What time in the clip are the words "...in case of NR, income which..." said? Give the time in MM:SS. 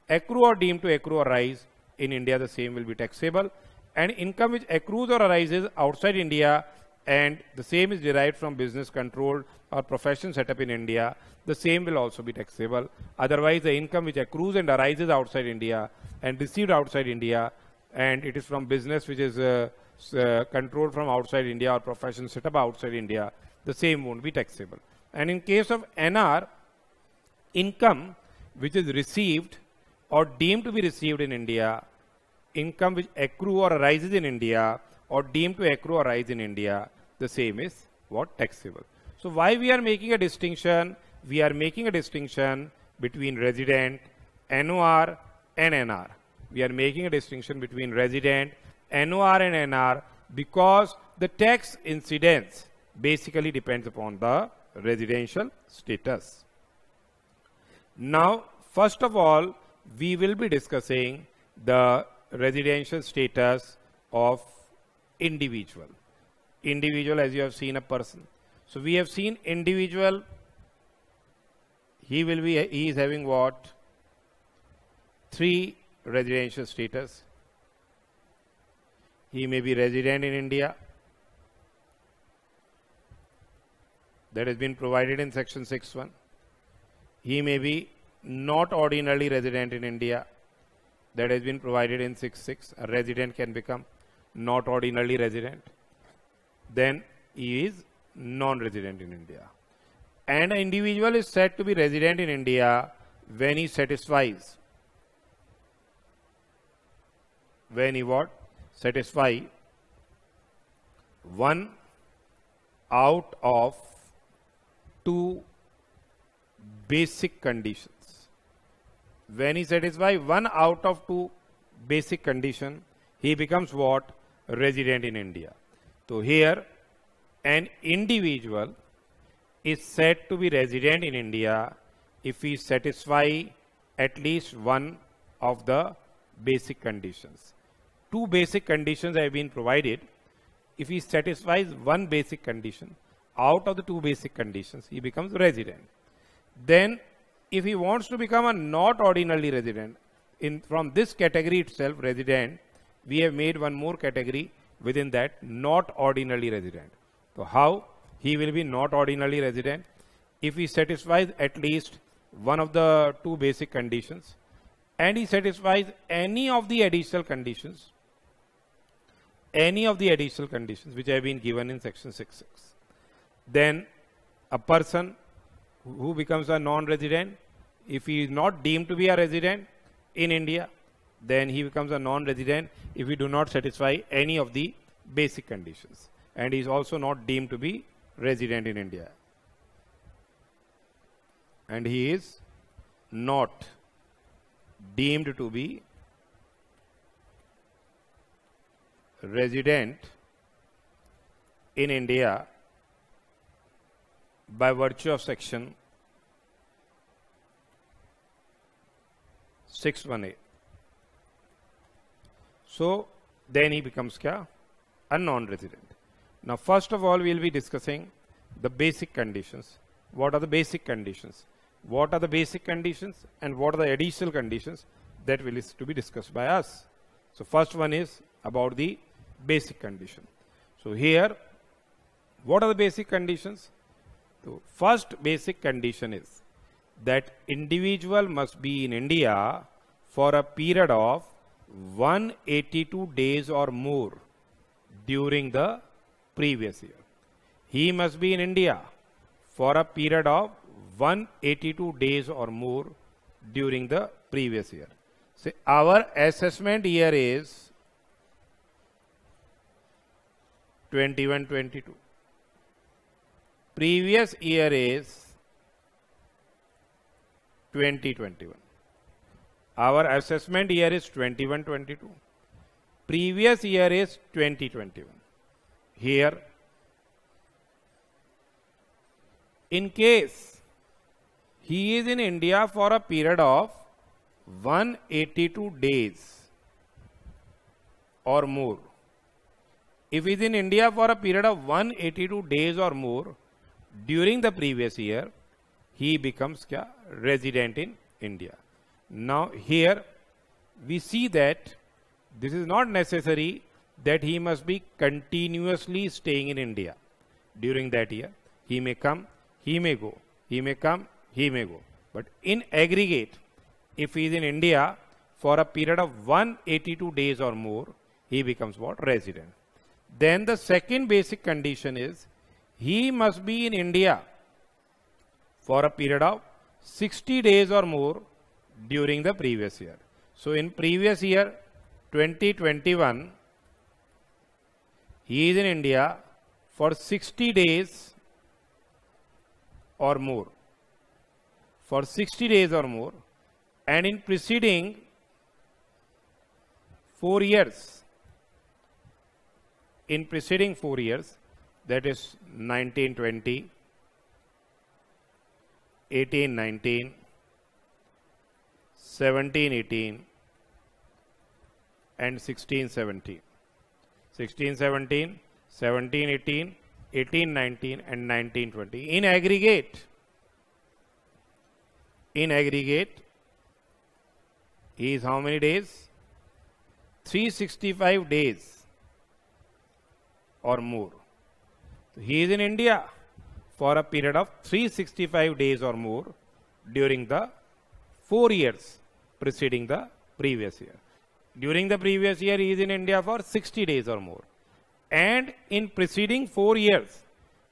00:25.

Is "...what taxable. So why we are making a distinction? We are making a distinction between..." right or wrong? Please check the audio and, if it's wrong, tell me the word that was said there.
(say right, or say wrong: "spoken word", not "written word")
right.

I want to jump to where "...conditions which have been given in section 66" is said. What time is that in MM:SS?
02:50.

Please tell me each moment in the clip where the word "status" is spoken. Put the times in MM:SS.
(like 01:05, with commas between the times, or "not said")
00:55, 01:03, 01:16.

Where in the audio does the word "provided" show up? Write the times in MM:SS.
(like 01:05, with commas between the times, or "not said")
01:24, 01:31, 02:19.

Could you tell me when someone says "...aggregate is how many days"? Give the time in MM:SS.
06:12.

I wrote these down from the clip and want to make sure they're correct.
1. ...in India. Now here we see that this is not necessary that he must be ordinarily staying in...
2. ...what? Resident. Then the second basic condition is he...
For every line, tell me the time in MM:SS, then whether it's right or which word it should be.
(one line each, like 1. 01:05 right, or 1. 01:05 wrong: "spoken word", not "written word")
1. 04:57 wrong: "continuously", not "ordinarily"
2. 05:18 right.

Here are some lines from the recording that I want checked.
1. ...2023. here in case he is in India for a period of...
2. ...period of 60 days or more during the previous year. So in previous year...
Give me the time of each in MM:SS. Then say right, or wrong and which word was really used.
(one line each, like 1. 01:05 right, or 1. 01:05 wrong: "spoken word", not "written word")
1. 04:34 wrong: "2021", not "2023"
2. 05:25 right.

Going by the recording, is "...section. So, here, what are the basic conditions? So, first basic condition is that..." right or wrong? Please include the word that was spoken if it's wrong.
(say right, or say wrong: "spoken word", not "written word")
wrong: "condition", not "section".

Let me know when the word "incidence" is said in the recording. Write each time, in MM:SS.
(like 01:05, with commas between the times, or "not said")
00:51.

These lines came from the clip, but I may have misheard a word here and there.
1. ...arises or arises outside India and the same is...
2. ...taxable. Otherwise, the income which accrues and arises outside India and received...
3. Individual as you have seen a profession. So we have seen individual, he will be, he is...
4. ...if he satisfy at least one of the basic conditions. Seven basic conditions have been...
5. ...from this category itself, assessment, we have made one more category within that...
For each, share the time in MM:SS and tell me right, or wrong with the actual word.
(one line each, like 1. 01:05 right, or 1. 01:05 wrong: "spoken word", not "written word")
1. 00:04 wrong: "accrues", not "arises"
2. 00:12 right
3. 01:06 wrong: "person", not "profession"
4. 02:12 wrong: "Two", not "Seven"
5. 02:30 wrong: "resident", not "assessment".